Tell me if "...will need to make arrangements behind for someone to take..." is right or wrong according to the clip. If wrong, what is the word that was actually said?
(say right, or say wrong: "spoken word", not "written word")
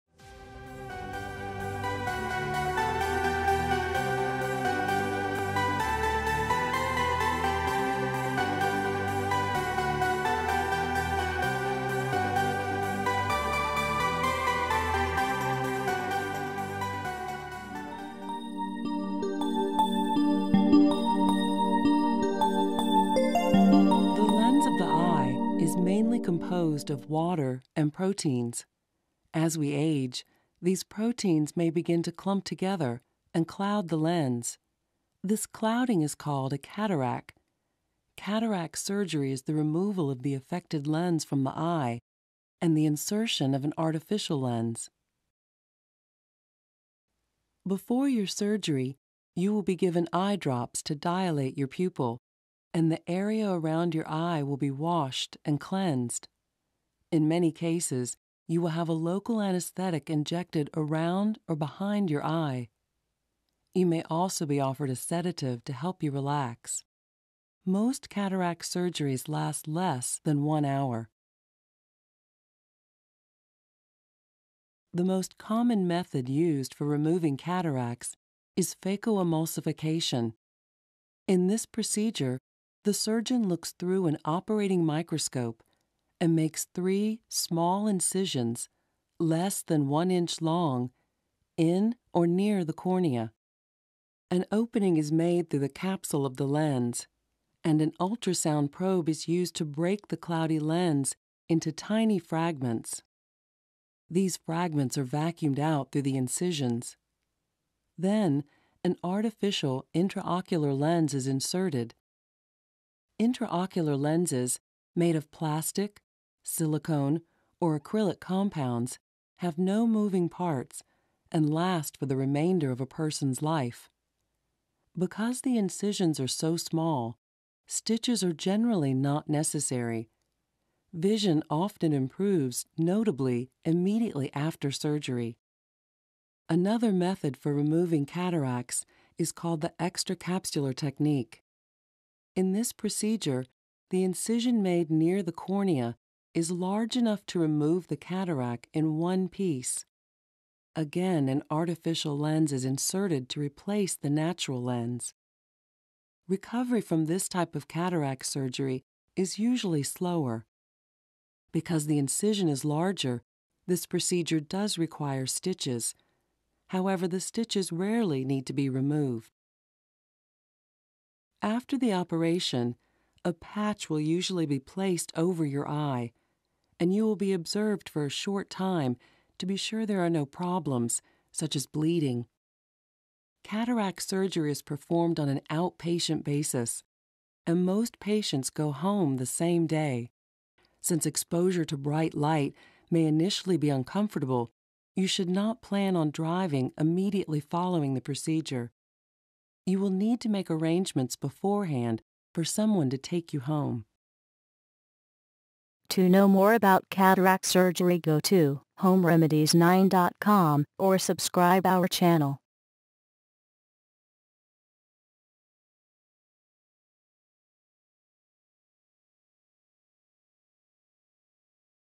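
wrong: "beforehand", not "behind".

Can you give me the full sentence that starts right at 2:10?
Vision often improves notably immediately after surgery.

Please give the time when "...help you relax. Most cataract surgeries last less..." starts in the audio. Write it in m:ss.
1:05.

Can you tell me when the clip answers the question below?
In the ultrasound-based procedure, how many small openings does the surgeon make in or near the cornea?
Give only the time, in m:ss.
1:26.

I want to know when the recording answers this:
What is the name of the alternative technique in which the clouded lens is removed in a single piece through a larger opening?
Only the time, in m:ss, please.
2:19.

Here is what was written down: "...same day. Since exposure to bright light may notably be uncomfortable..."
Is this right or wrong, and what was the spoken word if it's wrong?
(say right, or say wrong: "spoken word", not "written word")
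wrong: "initially", not "notably".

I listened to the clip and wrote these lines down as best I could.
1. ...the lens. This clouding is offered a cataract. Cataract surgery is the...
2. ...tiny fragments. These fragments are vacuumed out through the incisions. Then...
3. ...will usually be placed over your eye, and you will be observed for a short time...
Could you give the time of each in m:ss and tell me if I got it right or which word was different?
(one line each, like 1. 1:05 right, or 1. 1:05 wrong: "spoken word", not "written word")
1. 0:33 wrong: "called", not "offered"
2. 1:41 right
3. 2:53 right.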